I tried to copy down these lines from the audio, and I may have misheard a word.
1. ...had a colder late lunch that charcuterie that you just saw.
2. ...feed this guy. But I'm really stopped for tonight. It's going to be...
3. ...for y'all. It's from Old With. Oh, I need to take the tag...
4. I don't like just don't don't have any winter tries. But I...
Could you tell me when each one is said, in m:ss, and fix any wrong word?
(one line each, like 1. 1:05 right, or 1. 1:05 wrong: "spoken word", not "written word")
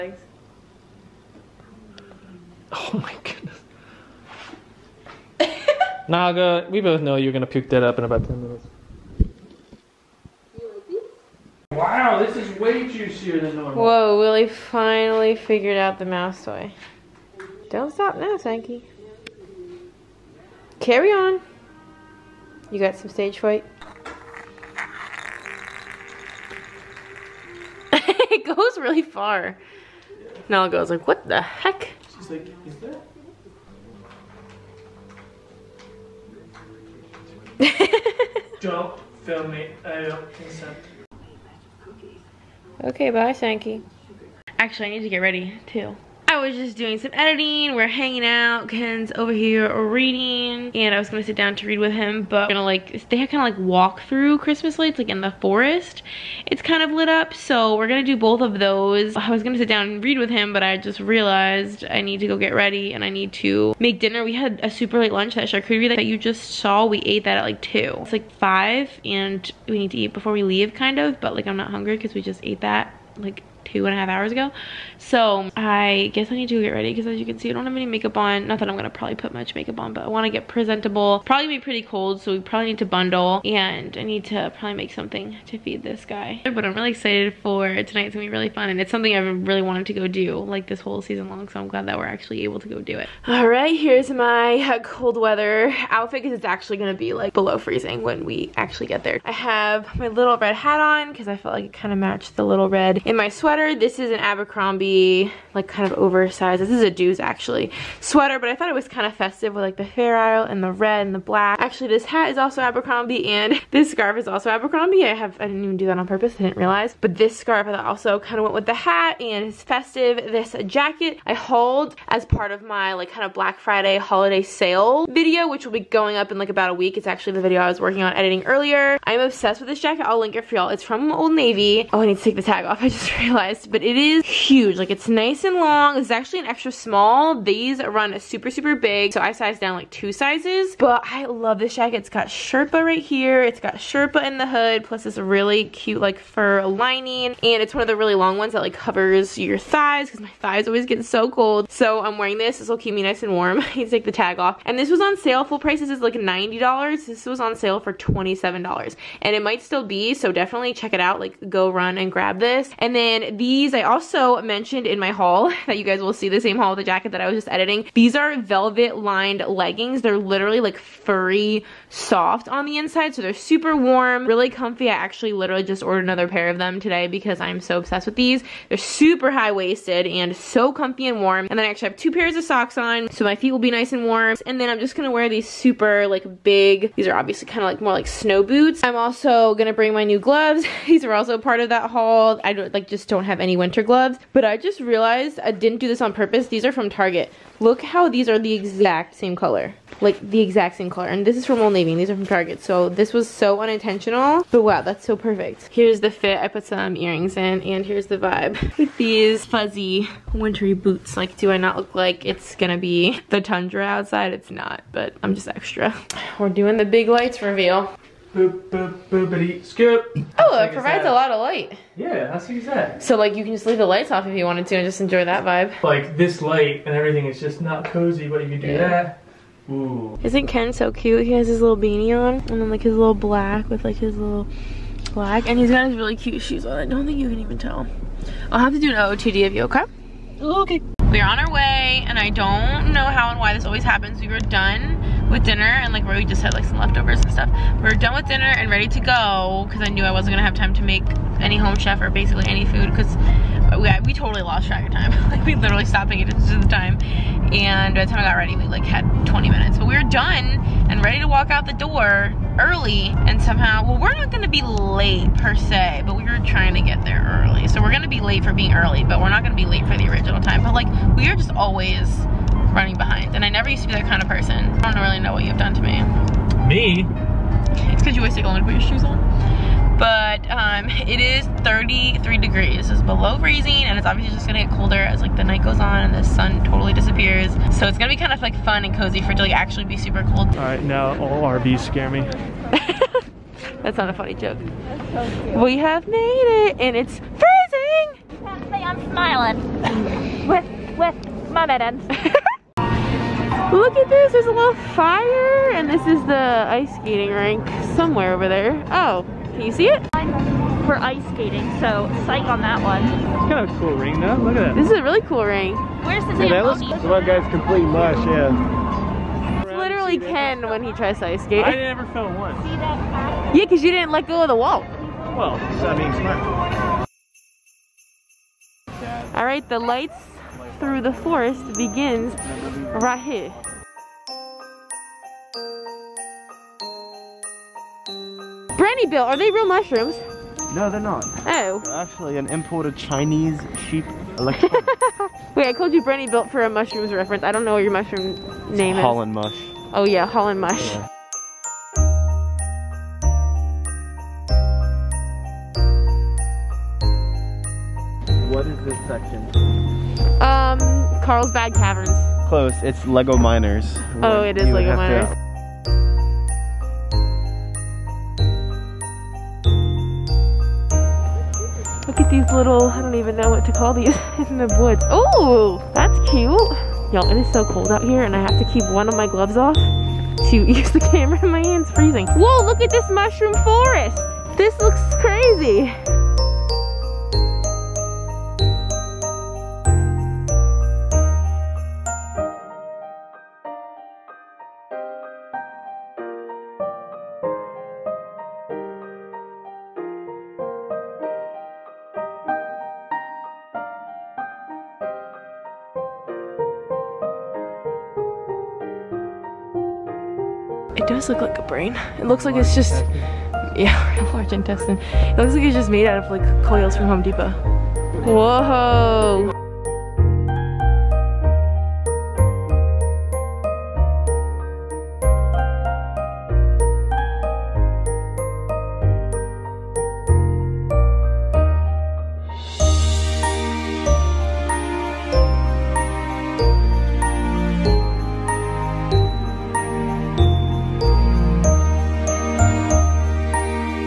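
1. 1:04 wrong: "super", not "colder"
2. 1:25 wrong: "excited", not "stopped"
3. 2:10 wrong: "Navy", not "With"
4. 3:12 wrong: "gloves", not "tries".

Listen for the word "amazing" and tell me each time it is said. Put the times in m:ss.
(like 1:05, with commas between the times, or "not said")
not said.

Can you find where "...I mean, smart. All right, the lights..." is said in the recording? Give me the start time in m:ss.
5:25.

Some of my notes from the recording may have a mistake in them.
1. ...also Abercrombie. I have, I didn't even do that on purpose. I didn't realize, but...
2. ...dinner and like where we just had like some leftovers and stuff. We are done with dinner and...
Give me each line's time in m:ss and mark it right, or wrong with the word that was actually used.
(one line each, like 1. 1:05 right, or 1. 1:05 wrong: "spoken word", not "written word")
1. 1:54 right
2. 4:05 right.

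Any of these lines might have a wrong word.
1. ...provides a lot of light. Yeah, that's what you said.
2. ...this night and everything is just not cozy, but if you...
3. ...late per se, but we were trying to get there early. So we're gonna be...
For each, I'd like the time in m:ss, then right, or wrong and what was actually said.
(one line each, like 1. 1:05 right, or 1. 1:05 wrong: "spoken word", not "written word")
1. 3:40 right
2. 3:46 wrong: "light", not "night"
3. 4:24 right.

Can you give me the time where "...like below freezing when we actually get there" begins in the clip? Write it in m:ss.
1:37.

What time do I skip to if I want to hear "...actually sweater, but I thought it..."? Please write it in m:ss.
1:47.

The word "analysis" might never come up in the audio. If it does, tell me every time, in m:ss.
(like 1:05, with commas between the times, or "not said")
not said.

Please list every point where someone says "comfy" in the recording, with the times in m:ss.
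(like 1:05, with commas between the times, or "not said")
2:54, 3:00.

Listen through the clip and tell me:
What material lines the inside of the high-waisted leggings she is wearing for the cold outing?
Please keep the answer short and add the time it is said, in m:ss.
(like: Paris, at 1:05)
Velvet, at 2:47.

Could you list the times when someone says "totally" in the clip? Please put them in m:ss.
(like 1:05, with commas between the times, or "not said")
4:14, 4:46.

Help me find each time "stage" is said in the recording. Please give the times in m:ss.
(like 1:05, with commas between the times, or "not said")
0:23.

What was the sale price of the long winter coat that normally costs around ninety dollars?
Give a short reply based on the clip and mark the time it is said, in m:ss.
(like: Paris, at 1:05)
$27, at 2:37.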